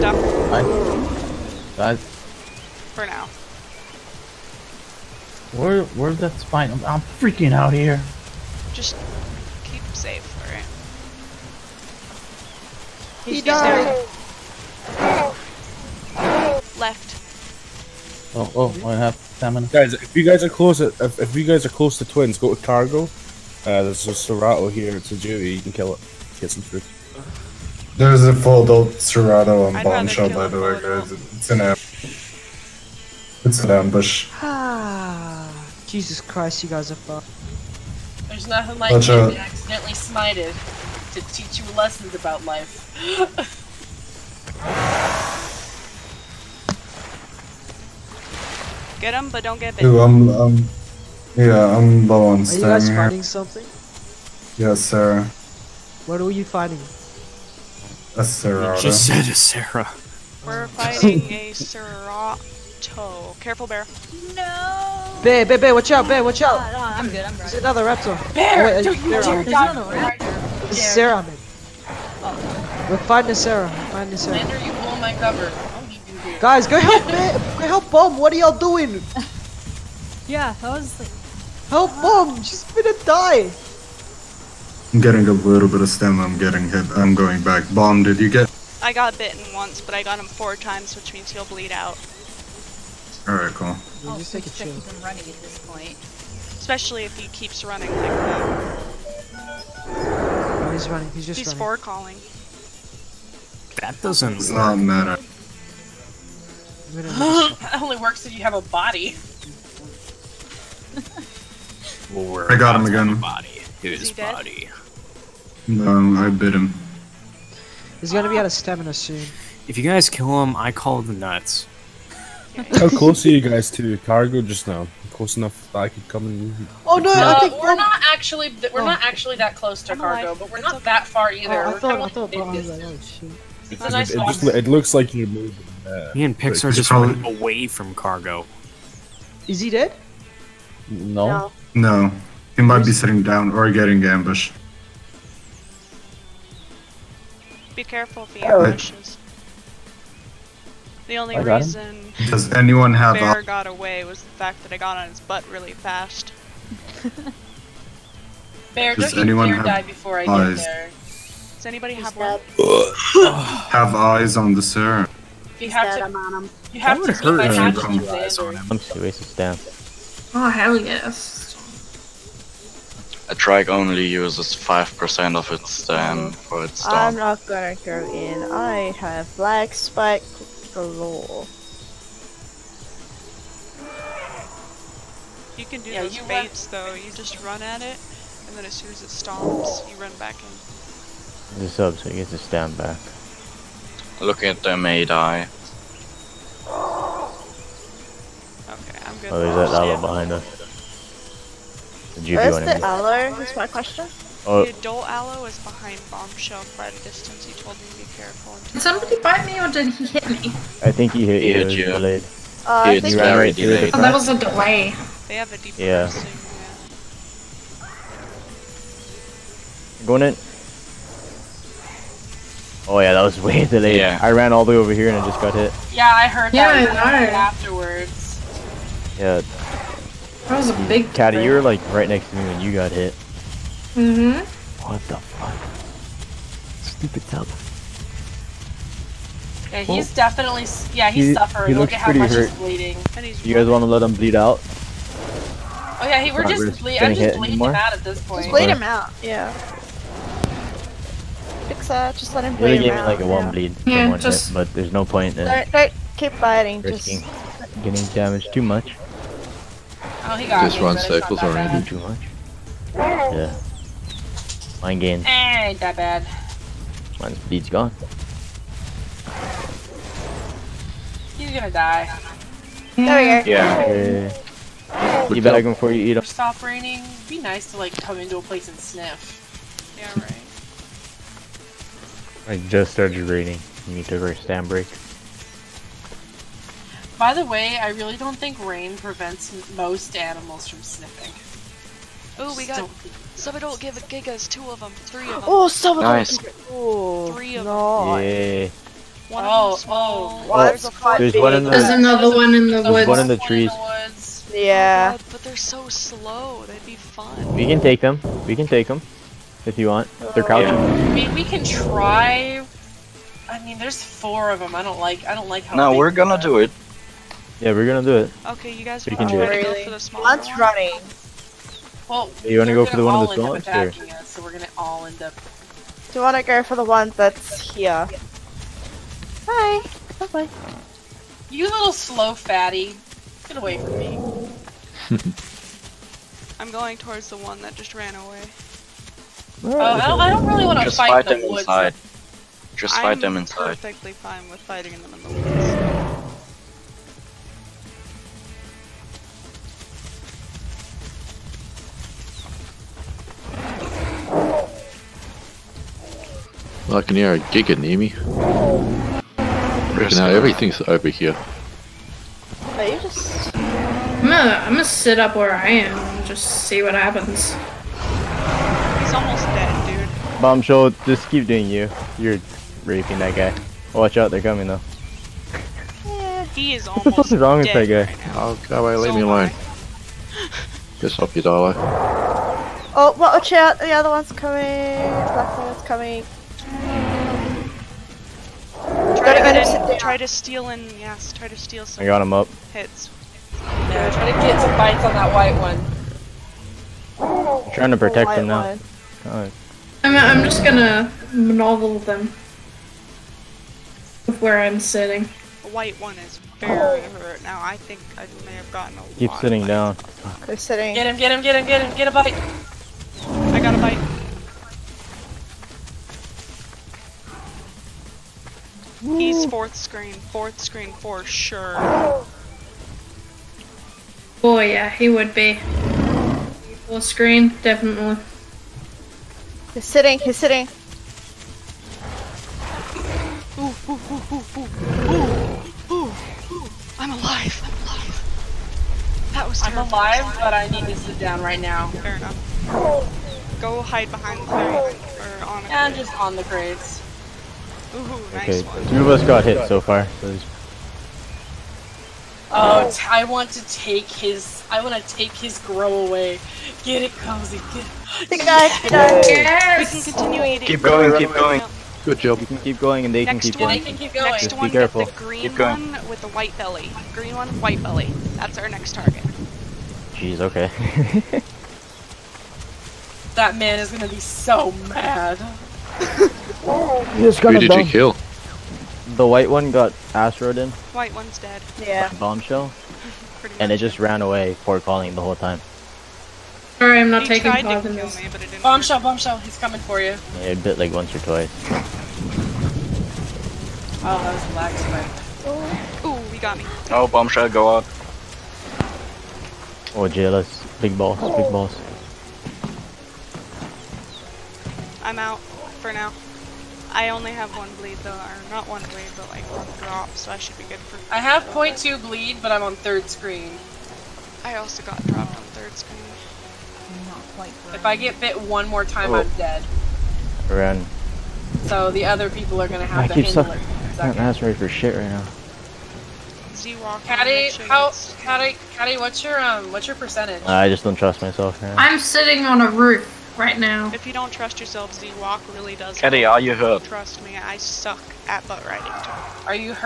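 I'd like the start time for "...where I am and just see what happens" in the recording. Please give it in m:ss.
6:05.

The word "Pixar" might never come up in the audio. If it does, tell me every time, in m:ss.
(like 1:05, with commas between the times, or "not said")
2:16, 4:11.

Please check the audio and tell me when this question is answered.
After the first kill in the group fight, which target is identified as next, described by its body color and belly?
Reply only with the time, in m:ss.
7:47.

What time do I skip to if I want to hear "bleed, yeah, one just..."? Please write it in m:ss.
4:13.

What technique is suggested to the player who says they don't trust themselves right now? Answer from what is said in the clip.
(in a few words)
Z-Walk.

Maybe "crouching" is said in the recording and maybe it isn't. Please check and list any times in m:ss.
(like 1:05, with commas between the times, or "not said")
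5:10.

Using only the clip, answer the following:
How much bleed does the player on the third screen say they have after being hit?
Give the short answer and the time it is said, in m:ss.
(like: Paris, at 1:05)
0.2, at 8:31.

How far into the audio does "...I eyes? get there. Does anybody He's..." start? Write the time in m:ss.
2:40.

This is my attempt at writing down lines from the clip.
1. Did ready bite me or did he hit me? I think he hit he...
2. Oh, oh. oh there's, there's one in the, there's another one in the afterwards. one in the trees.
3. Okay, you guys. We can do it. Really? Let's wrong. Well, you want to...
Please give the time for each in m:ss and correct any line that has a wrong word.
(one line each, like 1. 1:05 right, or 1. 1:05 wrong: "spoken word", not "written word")
1. 3:28 wrong: "somebody", not "ready"
2. 4:59 wrong: "woods", not "afterwards"
3. 5:18 wrong: "running", not "wrong".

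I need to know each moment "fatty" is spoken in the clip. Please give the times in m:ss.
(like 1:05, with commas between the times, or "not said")
5:32.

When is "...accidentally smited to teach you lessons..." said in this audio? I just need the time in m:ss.
0:39.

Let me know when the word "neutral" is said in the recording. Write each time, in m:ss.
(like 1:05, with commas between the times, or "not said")
not said.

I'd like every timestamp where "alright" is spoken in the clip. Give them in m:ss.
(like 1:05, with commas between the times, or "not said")
0:13, 1:33.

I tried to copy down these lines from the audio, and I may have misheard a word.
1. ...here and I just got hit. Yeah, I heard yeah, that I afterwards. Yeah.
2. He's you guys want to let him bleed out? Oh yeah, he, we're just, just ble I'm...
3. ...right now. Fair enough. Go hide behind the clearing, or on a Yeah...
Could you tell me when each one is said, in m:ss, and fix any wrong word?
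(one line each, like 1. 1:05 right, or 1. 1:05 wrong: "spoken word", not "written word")
1. 3:44 right
2. 4:03 right
3. 7:21 right.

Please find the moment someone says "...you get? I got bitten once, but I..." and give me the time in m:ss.
1:28.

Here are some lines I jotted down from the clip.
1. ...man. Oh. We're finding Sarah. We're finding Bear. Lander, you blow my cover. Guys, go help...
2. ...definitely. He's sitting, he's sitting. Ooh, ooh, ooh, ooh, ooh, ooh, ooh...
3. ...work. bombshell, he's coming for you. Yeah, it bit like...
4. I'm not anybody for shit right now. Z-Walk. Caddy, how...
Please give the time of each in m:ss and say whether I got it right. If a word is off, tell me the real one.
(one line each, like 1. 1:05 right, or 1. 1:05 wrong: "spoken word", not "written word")
1. 1:11 wrong: "Sarah", not "Bear"
2. 7:07 right
3. 8:08 right
4. 8:44 wrong: "ready", not "anybody".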